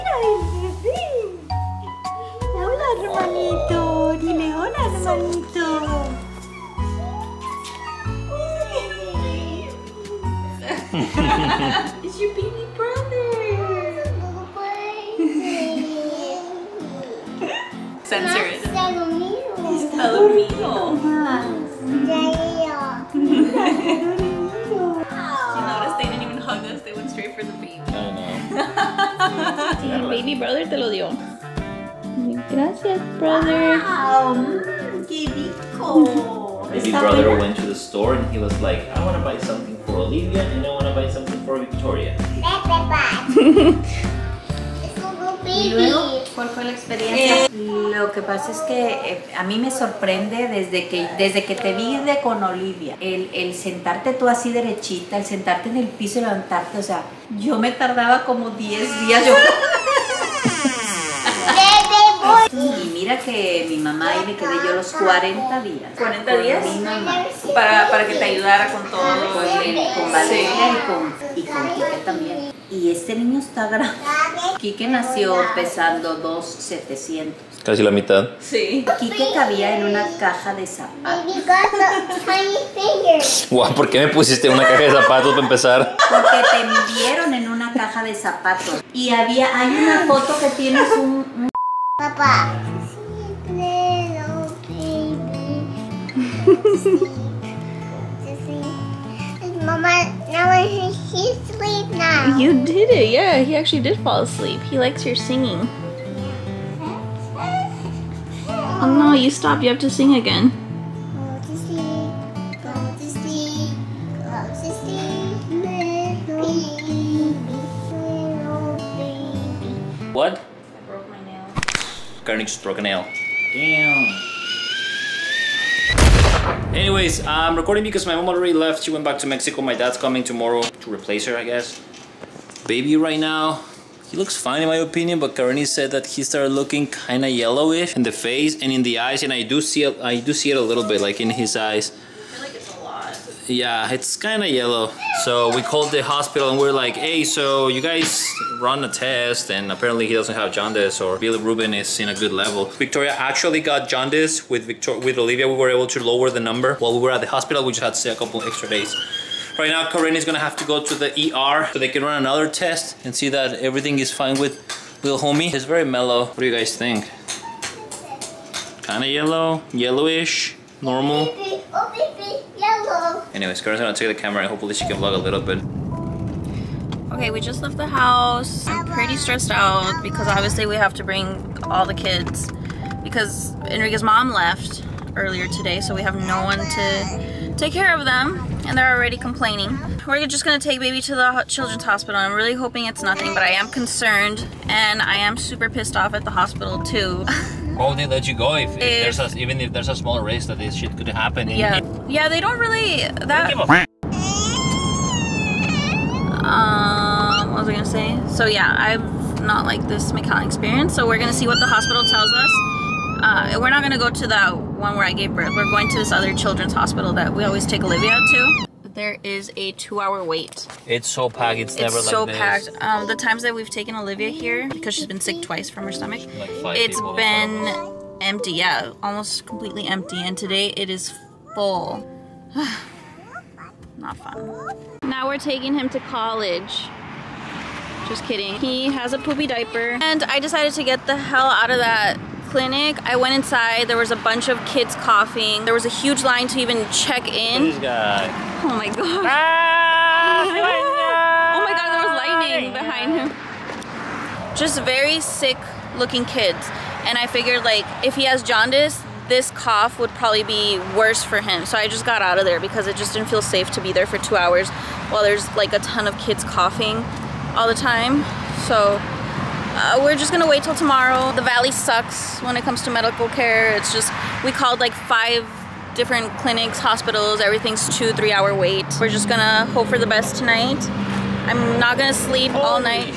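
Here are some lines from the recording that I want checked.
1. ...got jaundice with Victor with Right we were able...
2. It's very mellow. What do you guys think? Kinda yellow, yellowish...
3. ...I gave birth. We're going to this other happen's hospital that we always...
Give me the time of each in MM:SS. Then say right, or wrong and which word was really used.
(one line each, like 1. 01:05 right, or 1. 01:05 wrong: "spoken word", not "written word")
1. 02:33 wrong: "Olivia", not "Right"
2. 02:45 right
3. 03:35 wrong: "children", not "happen".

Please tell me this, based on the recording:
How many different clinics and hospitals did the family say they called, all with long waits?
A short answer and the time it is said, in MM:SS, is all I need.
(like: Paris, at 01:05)
5, at 04:34.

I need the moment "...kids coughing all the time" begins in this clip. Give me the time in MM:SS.
04:26.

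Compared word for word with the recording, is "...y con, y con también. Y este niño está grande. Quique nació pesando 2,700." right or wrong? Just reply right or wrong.
right.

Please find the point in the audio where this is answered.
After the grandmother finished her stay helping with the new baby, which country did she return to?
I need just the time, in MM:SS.
02:09.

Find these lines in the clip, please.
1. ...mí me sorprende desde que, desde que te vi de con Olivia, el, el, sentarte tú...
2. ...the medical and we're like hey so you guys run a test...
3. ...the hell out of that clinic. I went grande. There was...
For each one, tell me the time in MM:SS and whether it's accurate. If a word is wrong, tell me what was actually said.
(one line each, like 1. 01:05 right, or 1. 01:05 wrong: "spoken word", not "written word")
1. 00:49 right
2. 02:25 wrong: "hospital", not "medical"
3. 04:01 wrong: "inside", not "grande".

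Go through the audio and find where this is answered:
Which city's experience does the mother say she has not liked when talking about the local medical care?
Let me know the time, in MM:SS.
03:30.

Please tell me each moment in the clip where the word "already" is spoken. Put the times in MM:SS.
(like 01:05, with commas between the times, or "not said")
02:08, 03:08.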